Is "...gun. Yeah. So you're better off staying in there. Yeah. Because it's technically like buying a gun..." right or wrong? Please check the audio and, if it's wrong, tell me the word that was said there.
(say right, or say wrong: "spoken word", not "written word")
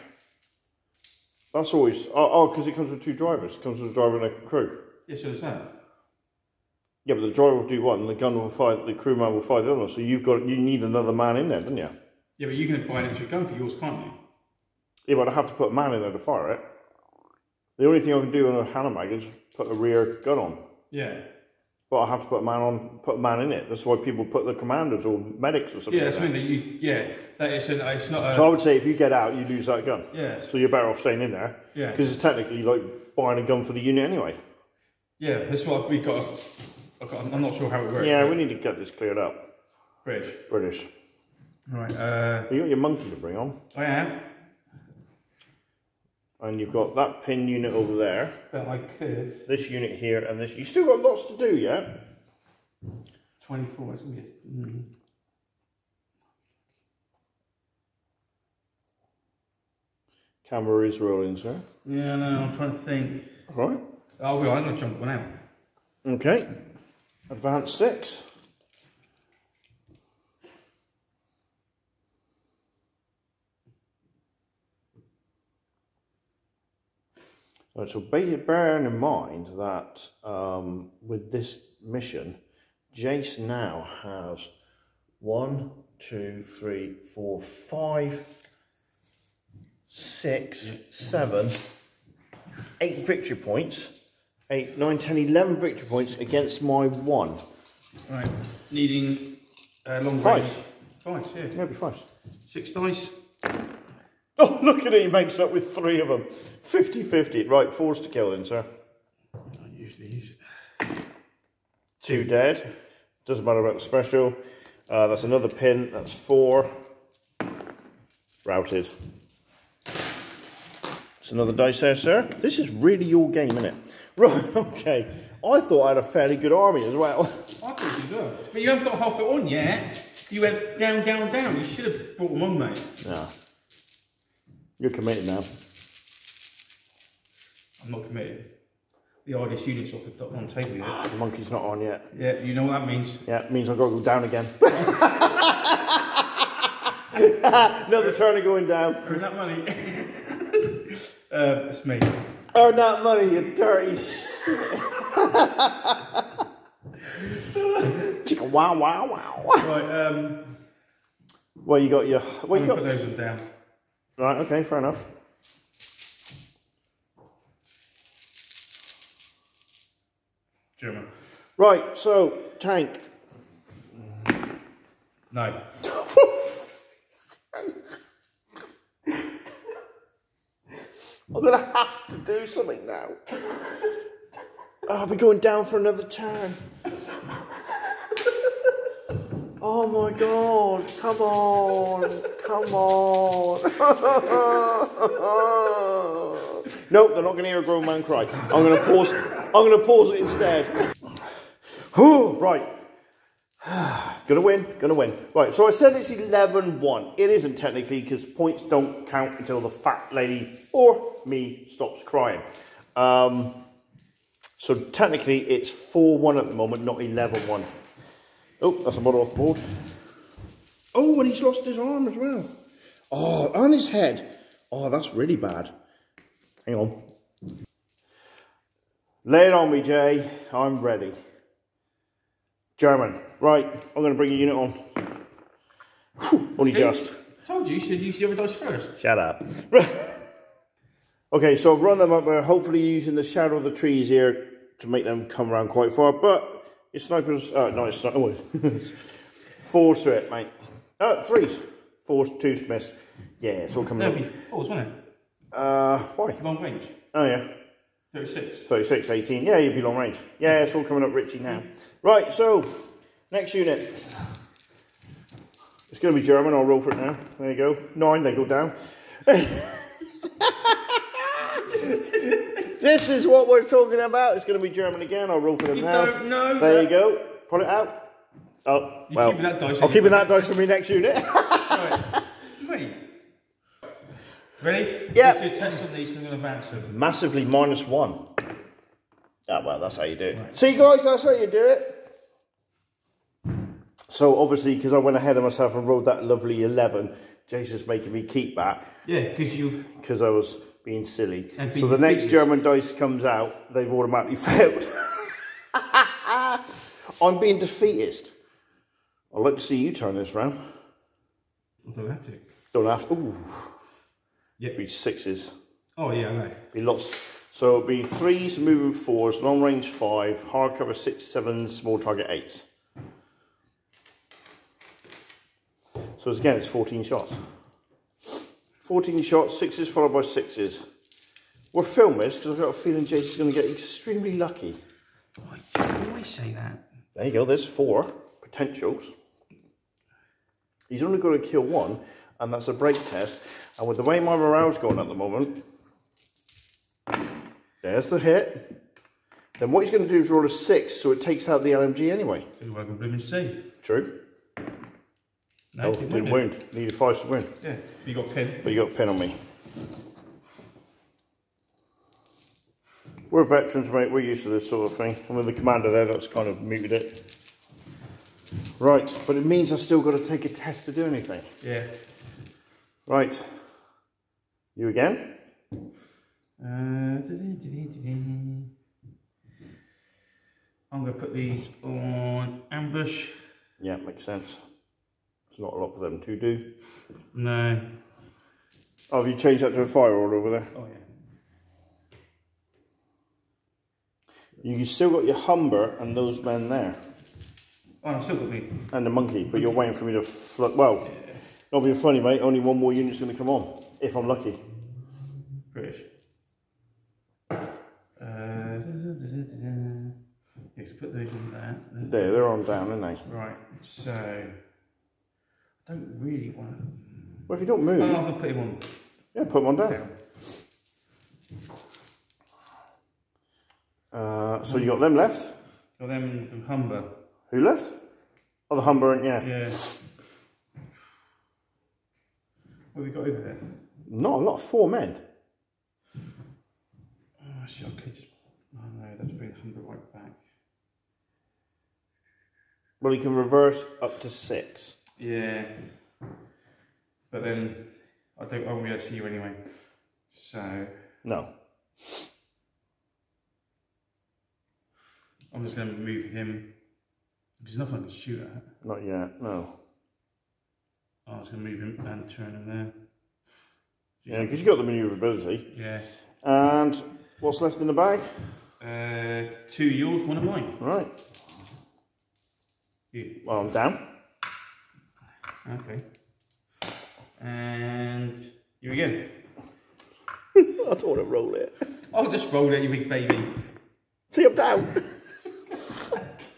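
right.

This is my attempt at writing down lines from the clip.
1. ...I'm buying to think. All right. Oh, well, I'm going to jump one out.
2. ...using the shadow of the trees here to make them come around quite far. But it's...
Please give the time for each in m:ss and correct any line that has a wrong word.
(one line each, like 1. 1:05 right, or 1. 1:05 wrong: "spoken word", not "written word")
1. 1:02 wrong: "trying", not "buying"
2. 4:02 right.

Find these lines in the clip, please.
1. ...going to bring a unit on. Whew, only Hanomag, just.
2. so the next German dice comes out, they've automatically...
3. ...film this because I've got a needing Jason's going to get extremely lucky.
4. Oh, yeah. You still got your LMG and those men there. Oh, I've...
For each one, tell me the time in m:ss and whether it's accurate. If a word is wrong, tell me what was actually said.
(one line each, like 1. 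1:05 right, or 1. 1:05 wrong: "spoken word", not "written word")
1. 3:54 wrong: "See", not "Hanomag"
2. 5:01 right
3. 5:31 wrong: "feeling", not "needing"
4. 6:30 wrong: "Humber", not "LMG".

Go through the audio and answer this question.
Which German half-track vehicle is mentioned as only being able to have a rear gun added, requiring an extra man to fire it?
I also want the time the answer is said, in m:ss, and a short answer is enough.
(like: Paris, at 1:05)
Hanomag, at 0:18.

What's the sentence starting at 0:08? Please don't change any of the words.
The crewman will fight the other.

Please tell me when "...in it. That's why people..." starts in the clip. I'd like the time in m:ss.
0:23.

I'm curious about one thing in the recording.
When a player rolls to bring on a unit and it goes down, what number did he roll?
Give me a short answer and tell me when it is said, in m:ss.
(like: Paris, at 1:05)
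9, at 4:27.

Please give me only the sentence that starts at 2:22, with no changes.
Yeah, you know what that means.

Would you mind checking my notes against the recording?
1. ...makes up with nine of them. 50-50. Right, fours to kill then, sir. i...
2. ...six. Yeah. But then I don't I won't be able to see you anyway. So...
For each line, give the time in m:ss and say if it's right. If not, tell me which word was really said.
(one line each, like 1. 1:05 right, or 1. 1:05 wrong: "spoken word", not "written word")
1. 1:45 wrong: "three", not "nine"
2. 7:24 right.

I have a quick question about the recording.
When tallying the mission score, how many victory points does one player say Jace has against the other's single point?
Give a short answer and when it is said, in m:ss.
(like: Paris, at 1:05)
11, at 1:35.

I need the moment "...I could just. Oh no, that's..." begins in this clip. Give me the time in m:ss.
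7:17.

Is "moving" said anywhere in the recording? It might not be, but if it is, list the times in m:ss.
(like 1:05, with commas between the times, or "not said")
5:18.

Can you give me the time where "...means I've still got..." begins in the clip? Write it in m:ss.
6:09.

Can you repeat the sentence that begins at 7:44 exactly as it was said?
yeah, because you've got the manoeuvrability.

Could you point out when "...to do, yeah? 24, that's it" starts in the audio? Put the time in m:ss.
0:51.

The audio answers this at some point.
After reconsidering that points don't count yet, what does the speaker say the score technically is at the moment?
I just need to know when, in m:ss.
3:35.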